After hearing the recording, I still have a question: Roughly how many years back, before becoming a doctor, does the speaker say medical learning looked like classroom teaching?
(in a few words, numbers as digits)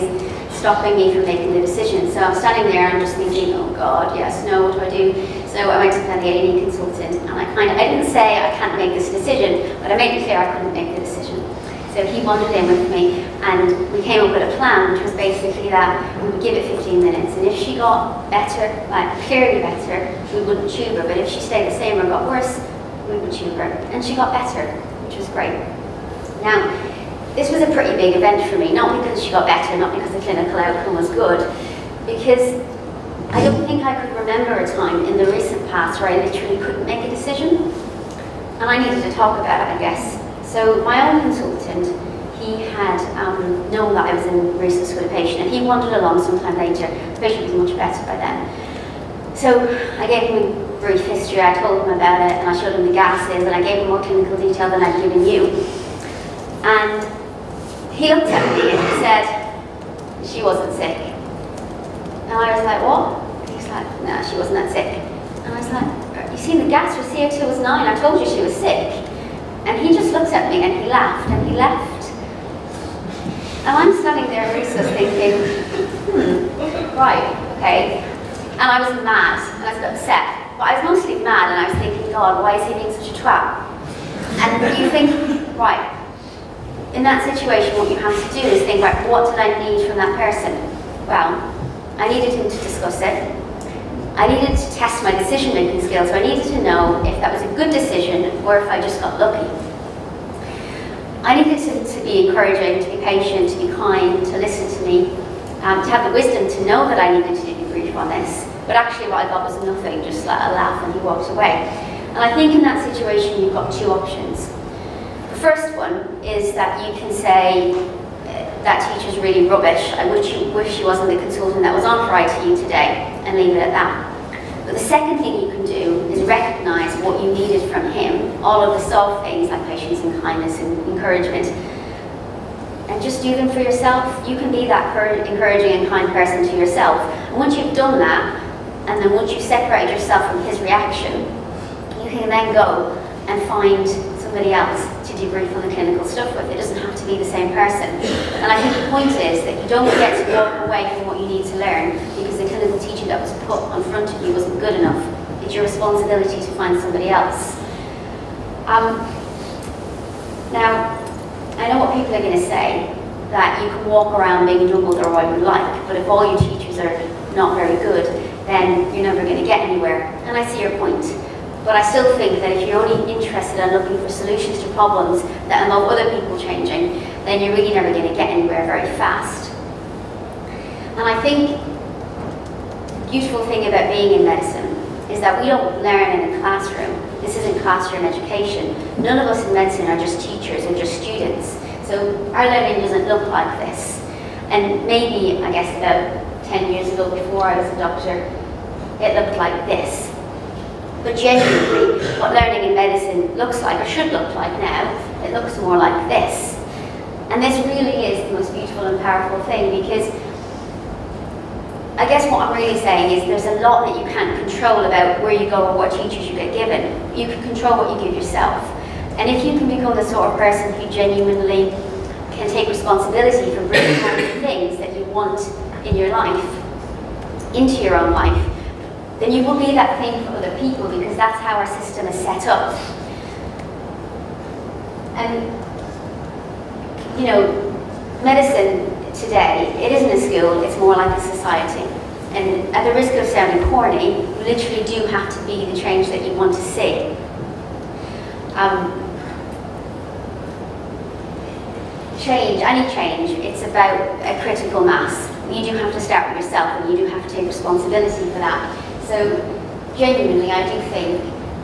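10 years.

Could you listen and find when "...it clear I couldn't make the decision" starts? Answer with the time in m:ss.
0:10.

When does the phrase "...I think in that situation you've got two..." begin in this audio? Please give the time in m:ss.
1:52.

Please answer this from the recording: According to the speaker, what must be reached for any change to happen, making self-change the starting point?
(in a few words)
critical mass.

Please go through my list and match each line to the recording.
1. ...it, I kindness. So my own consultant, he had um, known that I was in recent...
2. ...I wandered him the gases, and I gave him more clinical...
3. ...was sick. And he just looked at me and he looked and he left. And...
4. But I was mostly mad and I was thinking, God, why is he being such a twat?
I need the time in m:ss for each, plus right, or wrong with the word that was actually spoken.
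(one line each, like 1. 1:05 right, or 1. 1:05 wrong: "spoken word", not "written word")
1. 0:39 wrong: "guess", not "kindness"
2. 0:52 wrong: "showed", not "wandered"
3. 1:08 wrong: "laughed", not "looked"
4. 1:20 right.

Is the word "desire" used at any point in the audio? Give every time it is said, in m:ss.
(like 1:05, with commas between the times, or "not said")
not said.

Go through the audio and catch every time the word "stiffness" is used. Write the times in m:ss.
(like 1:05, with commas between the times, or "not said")
not said.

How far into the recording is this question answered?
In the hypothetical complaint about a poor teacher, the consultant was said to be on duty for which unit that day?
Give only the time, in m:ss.
2:02.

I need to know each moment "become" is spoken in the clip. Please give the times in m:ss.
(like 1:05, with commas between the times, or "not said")
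3:39.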